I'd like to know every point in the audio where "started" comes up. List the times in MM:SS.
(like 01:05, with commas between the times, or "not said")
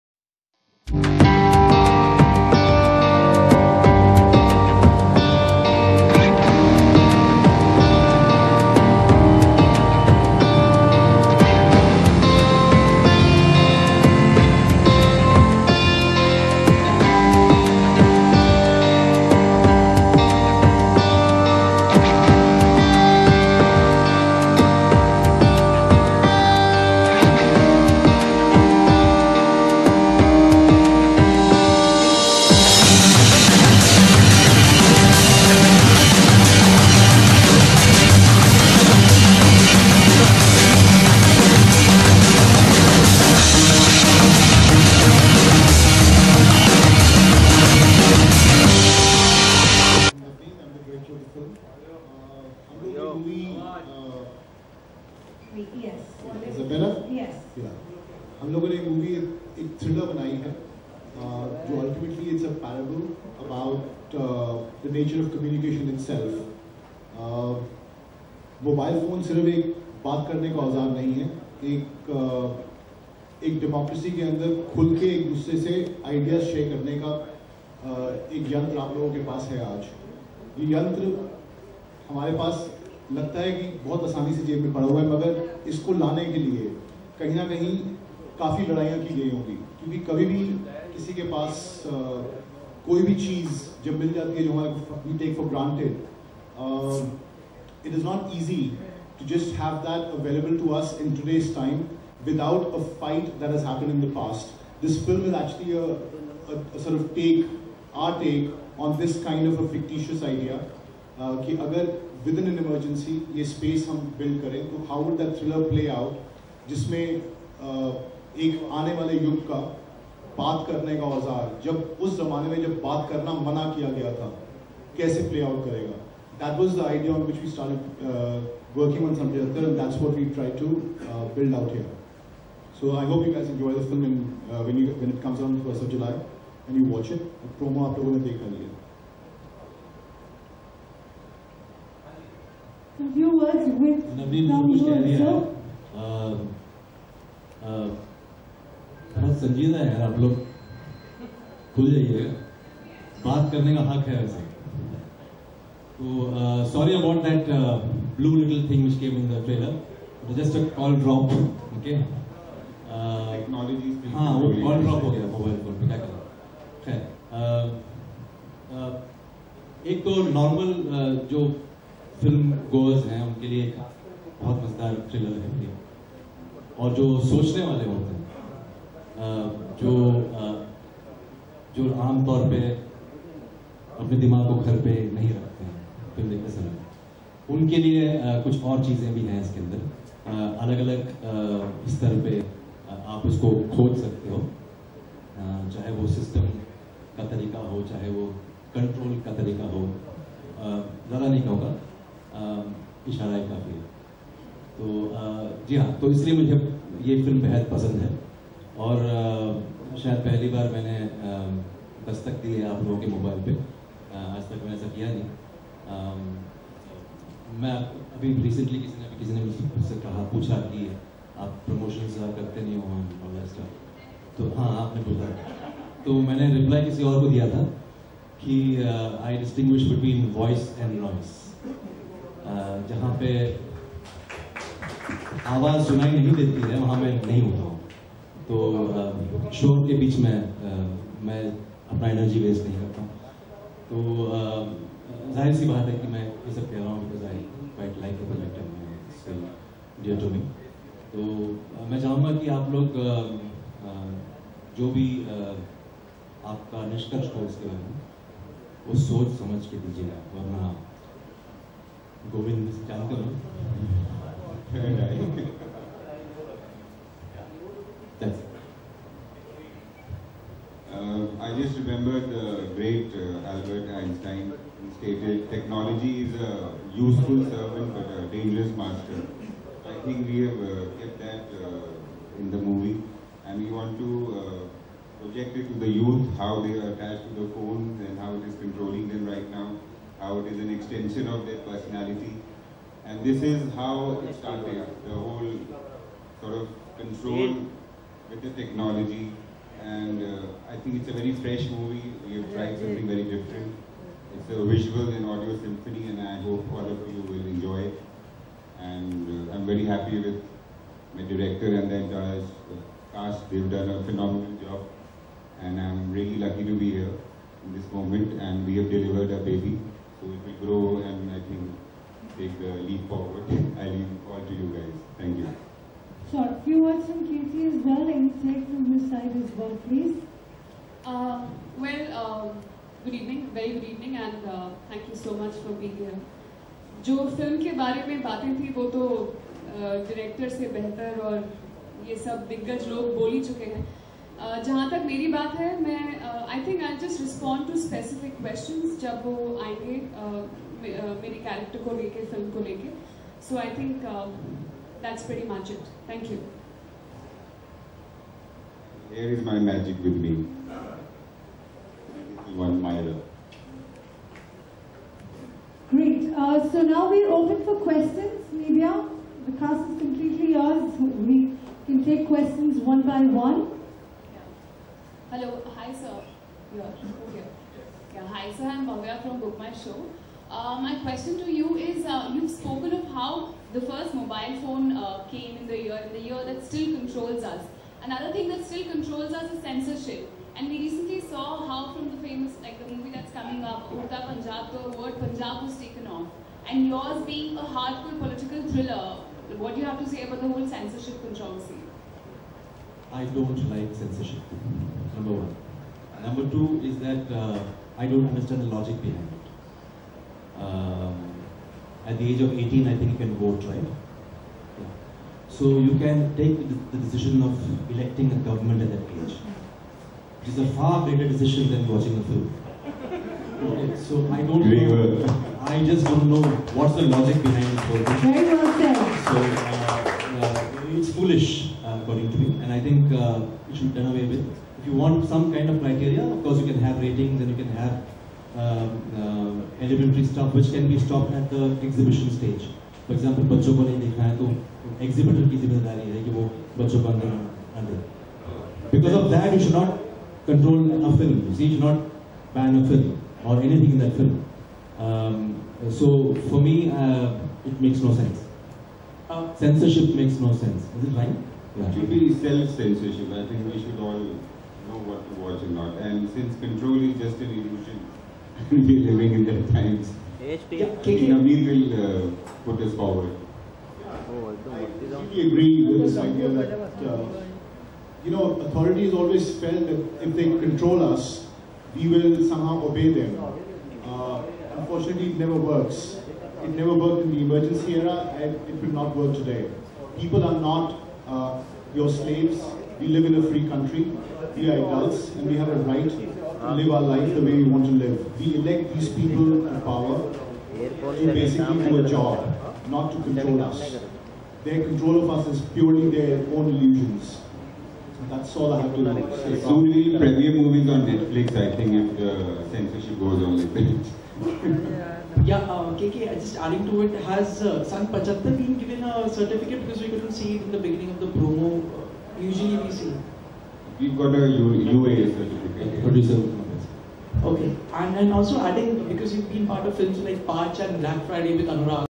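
02:07, 04:54.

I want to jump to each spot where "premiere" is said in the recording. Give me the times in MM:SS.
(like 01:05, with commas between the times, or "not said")
08:30.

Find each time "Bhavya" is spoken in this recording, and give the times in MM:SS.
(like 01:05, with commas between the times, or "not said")
06:18.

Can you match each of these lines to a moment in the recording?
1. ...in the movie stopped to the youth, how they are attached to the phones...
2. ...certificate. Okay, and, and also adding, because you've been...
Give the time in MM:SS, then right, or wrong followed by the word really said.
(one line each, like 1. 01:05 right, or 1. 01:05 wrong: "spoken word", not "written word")
1. 04:42 wrong: "subjected", not "stopped"
2. 08:45 right.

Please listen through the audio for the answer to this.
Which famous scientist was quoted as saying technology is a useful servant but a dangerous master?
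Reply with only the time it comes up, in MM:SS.
04:33.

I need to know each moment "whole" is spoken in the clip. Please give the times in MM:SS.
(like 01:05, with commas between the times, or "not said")
04:55, 06:40.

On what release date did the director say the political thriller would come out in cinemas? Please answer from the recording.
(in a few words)
1st of July.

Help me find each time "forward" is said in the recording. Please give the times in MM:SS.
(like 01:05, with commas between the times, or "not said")
05:23, 07:52.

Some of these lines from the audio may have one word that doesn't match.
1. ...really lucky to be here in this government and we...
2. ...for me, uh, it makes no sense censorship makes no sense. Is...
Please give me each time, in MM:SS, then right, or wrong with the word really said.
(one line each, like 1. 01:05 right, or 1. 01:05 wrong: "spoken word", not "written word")
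1. 05:16 wrong: "moment", not "government"
2. 07:36 right.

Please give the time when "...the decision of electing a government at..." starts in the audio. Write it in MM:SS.
06:56.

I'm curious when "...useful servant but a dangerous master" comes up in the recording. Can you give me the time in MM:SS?
04:36.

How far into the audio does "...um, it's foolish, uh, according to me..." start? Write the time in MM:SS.
07:09.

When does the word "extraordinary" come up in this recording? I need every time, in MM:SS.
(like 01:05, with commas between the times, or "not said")
not said.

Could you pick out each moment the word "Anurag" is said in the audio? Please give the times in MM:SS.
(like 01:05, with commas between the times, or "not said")
08:51.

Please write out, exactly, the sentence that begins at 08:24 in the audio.
Their control of us is purely their own illusions.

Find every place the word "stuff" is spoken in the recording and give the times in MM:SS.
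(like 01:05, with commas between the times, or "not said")
07:20.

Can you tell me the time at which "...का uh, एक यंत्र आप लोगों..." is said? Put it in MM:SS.
01:17.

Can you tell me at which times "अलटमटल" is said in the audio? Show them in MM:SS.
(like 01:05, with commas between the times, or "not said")
01:01.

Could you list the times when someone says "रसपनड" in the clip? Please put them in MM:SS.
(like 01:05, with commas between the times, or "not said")
05:47.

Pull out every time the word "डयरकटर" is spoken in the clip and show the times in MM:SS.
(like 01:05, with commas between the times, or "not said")
05:39.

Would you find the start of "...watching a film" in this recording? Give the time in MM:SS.
07:01.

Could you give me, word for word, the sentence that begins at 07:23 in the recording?
For example, if को नहीं not है तो exhibitor की जिम्मेदारी है Because of that, you should not control a film.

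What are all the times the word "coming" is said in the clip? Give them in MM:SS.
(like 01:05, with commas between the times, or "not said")
06:33.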